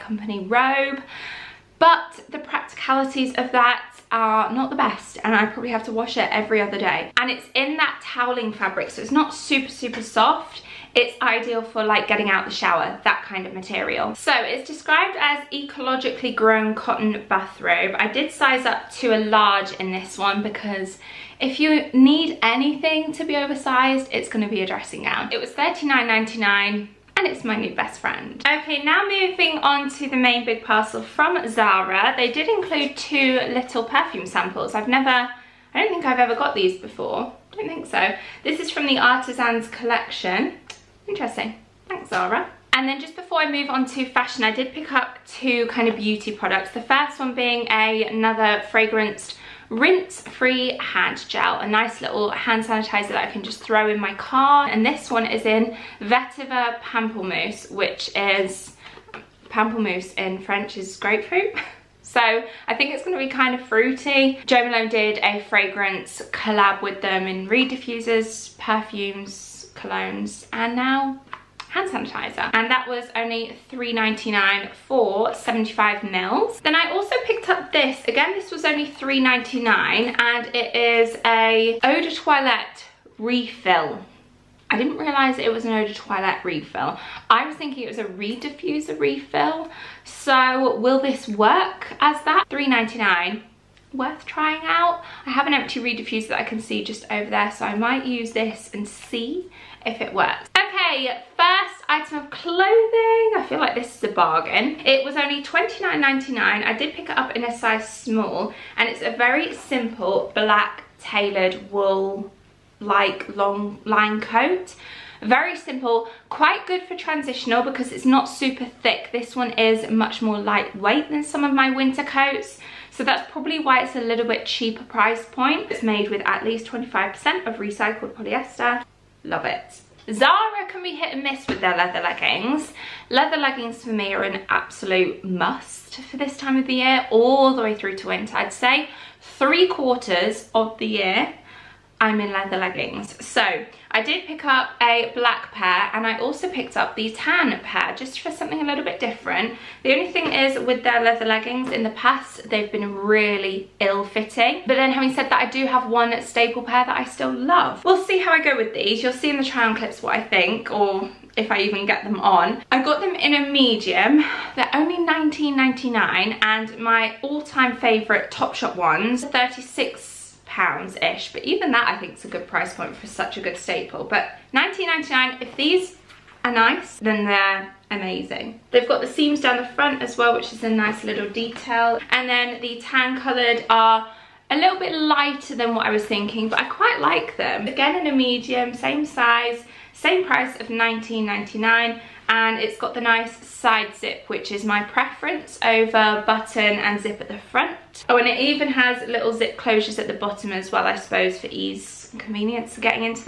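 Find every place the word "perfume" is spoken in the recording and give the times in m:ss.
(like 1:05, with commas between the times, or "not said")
0:33, 1:08.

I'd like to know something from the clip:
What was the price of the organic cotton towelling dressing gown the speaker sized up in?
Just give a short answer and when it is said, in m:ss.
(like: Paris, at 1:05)
39.99, at 0:25.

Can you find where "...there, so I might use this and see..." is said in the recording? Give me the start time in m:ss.
1:37.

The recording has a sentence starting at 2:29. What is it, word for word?
The only thing is with their leather leggings in the past, they've been really ill fitting.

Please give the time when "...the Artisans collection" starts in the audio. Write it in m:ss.
0:38.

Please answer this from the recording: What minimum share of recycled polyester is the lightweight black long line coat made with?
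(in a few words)
25%.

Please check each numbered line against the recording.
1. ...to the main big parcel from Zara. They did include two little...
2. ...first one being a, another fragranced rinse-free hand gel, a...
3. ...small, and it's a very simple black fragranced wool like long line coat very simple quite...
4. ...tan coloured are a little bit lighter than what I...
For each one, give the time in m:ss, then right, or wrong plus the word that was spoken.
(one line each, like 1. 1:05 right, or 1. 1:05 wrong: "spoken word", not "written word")
1. 0:29 right
2. 0:46 right
3. 1:47 wrong: "tailored", not "fragranced"
4. 3:02 right.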